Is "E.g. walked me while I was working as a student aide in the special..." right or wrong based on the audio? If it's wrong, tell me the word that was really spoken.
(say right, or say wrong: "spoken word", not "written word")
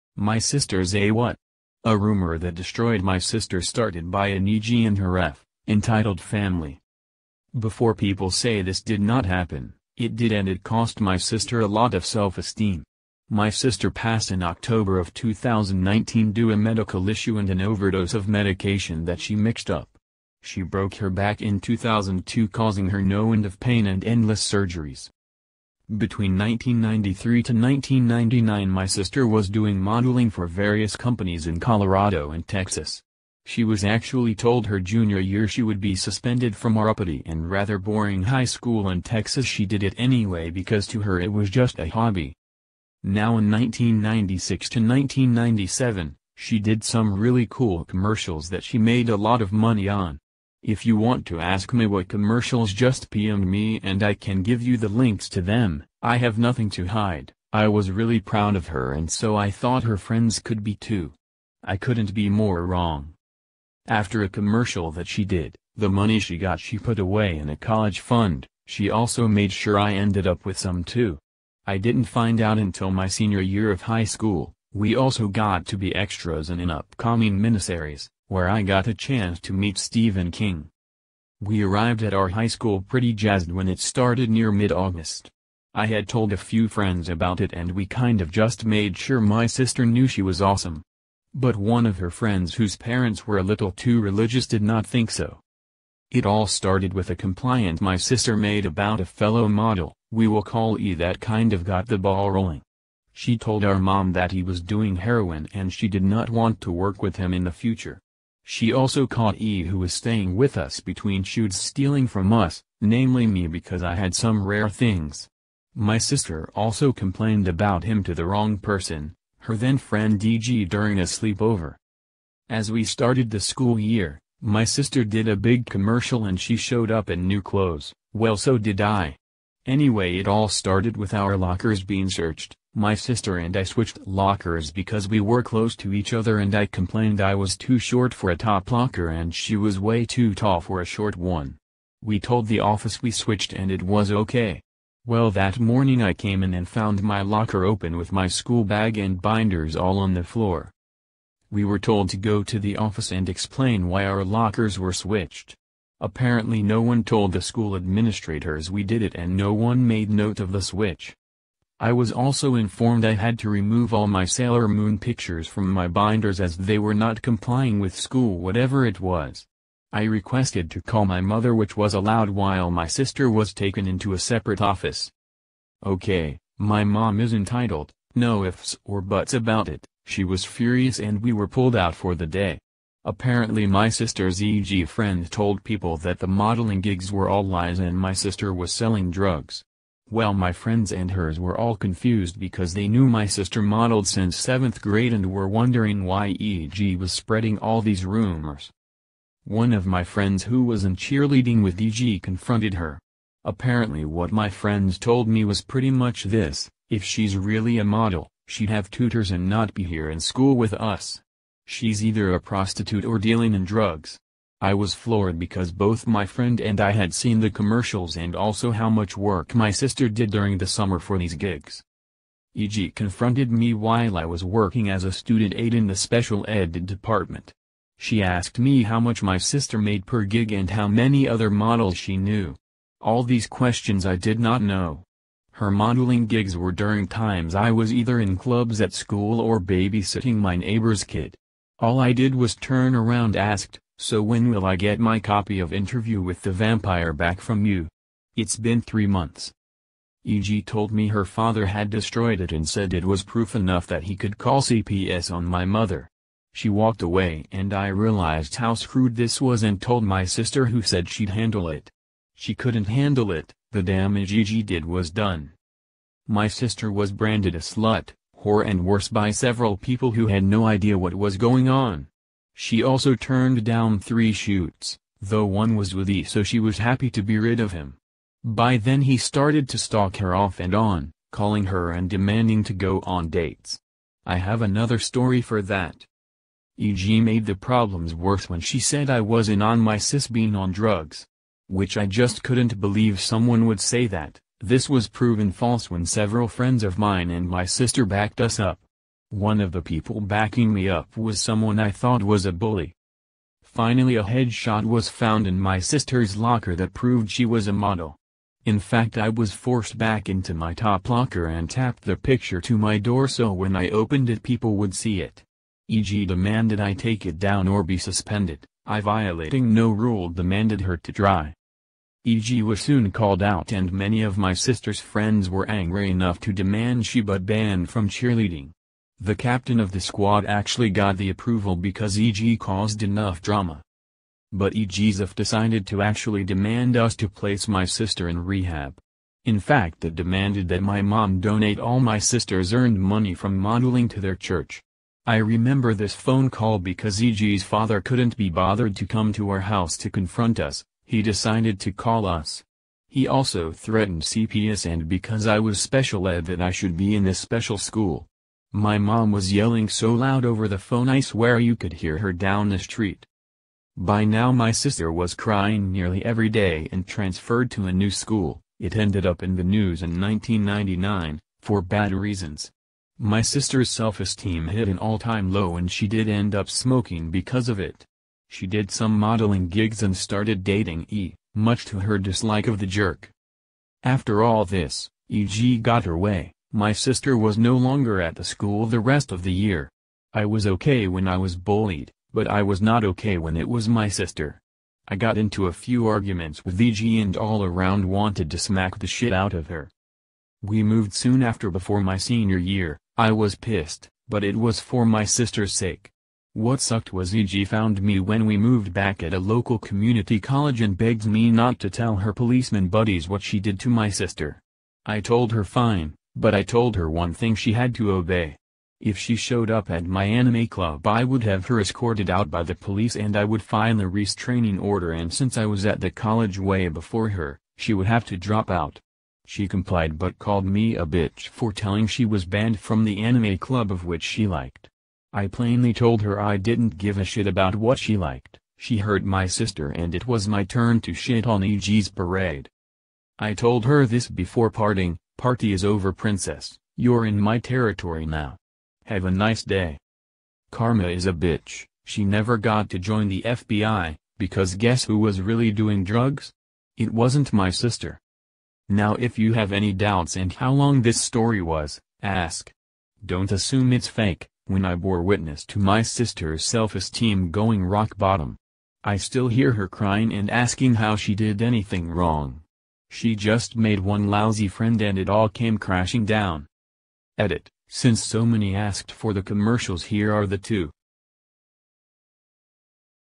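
wrong: "confronted", not "walked".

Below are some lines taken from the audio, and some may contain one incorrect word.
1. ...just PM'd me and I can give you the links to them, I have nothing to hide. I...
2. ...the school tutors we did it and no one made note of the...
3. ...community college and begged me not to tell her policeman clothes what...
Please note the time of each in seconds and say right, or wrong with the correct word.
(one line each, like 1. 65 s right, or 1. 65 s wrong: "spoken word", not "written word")
1. 52 s right
2. 157 s wrong: "administrators", not "tutors"
3. 409 s wrong: "buddies", not "clothes".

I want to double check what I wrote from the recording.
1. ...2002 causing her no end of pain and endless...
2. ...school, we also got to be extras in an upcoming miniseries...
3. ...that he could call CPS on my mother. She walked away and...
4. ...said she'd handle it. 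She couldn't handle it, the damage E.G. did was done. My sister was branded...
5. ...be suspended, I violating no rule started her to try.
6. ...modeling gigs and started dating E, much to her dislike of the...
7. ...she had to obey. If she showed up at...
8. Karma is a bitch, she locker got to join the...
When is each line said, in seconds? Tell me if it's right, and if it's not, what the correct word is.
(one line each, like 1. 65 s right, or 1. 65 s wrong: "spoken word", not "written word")
1. 21 s right
2. 74 s right
3. 253 s right
4. 260 s right
5. 317 s wrong: "demanded", not "started"
6. 379 s right
7. 417 s right
8. 450 s wrong: "never", not "locker".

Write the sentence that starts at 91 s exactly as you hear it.
But one of her friends whose parents were a little too religious did not think so.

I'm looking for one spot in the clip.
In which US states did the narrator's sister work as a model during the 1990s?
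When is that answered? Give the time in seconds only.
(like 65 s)
31 s.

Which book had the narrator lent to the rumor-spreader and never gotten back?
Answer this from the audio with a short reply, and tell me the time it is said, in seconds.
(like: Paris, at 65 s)
Interview with the Vampire, at 245 s.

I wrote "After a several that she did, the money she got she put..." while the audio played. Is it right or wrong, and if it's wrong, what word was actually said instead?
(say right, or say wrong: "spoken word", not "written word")
wrong: "commercial", not "several".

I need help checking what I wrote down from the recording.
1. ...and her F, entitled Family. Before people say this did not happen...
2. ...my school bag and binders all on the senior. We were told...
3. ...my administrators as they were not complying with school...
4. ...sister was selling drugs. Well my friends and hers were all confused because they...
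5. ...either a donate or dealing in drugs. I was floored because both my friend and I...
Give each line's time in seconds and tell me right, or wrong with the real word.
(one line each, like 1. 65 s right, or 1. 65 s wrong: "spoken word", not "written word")
1. 4 s right
2. 148 s wrong: "floor", not "senior"
3. 165 s wrong: "binders", not "administrators"
4. 188 s right
5. 212 s wrong: "prostitute", not "donate".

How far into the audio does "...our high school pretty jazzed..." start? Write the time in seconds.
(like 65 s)
82 s.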